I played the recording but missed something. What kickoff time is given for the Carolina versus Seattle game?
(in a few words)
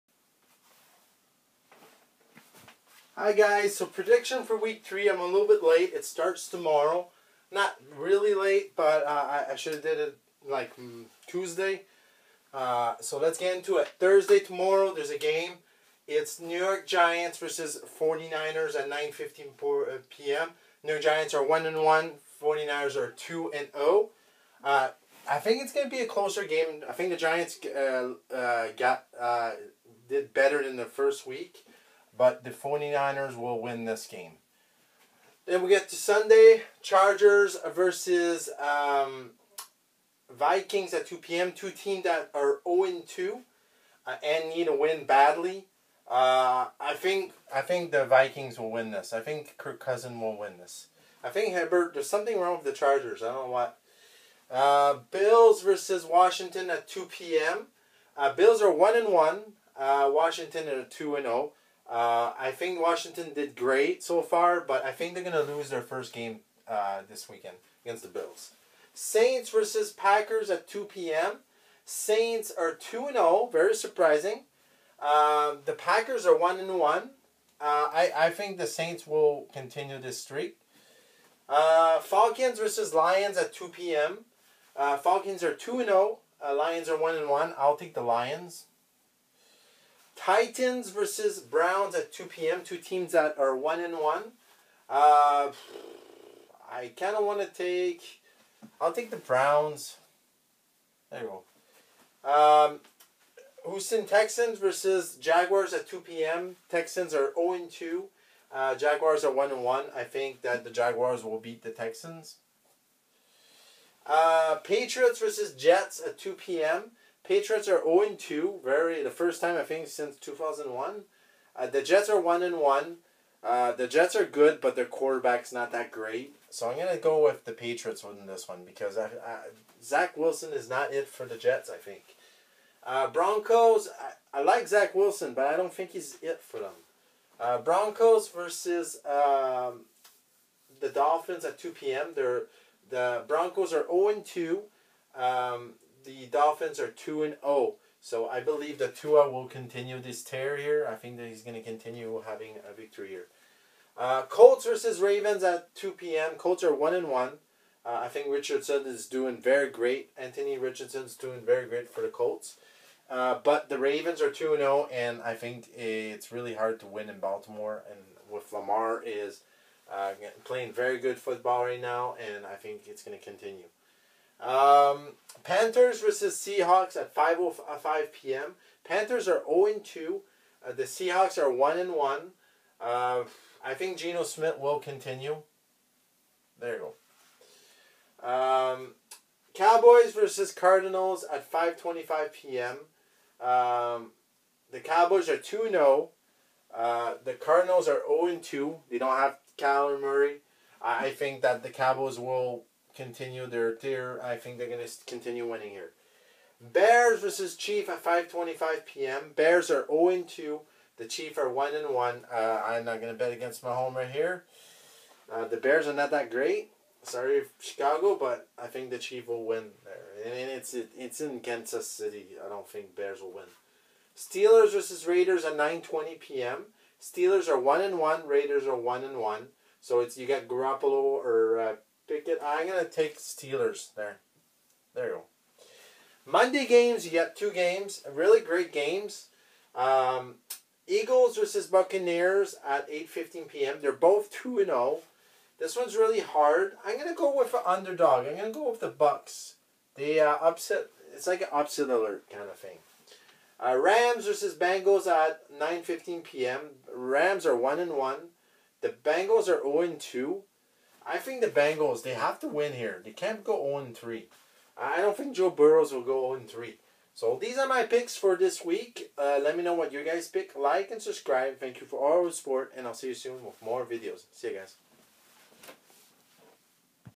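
5:05 p.m.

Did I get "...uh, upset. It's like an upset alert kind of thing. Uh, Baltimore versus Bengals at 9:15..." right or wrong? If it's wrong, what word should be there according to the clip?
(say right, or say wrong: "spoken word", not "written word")
wrong: "Rams", not "Baltimore".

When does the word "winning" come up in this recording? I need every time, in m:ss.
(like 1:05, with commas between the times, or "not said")
2:08, 3:25.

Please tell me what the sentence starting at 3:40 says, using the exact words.
And it's it, it's in Kansas City.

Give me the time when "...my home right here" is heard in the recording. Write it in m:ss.
3:33.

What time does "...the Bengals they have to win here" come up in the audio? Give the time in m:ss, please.
4:21.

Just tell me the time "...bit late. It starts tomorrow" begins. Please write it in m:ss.
0:05.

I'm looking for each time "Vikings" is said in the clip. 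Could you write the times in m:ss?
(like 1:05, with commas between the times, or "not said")
0:40, 0:48.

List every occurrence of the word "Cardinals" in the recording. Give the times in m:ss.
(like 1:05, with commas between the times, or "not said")
3:10, 3:17.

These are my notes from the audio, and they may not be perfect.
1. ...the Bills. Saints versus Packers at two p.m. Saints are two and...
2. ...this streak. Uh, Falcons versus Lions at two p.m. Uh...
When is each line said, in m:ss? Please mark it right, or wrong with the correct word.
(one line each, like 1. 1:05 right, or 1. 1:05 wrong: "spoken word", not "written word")
1. 1:08 right
2. 1:19 right.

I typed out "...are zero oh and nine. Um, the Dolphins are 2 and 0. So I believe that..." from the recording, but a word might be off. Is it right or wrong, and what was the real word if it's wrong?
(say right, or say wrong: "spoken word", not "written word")
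wrong: "two", not "nine".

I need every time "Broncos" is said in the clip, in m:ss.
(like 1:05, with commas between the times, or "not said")
2:13, 2:17, 2:23.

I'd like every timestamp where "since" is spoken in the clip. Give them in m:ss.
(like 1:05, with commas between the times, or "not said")
1:59.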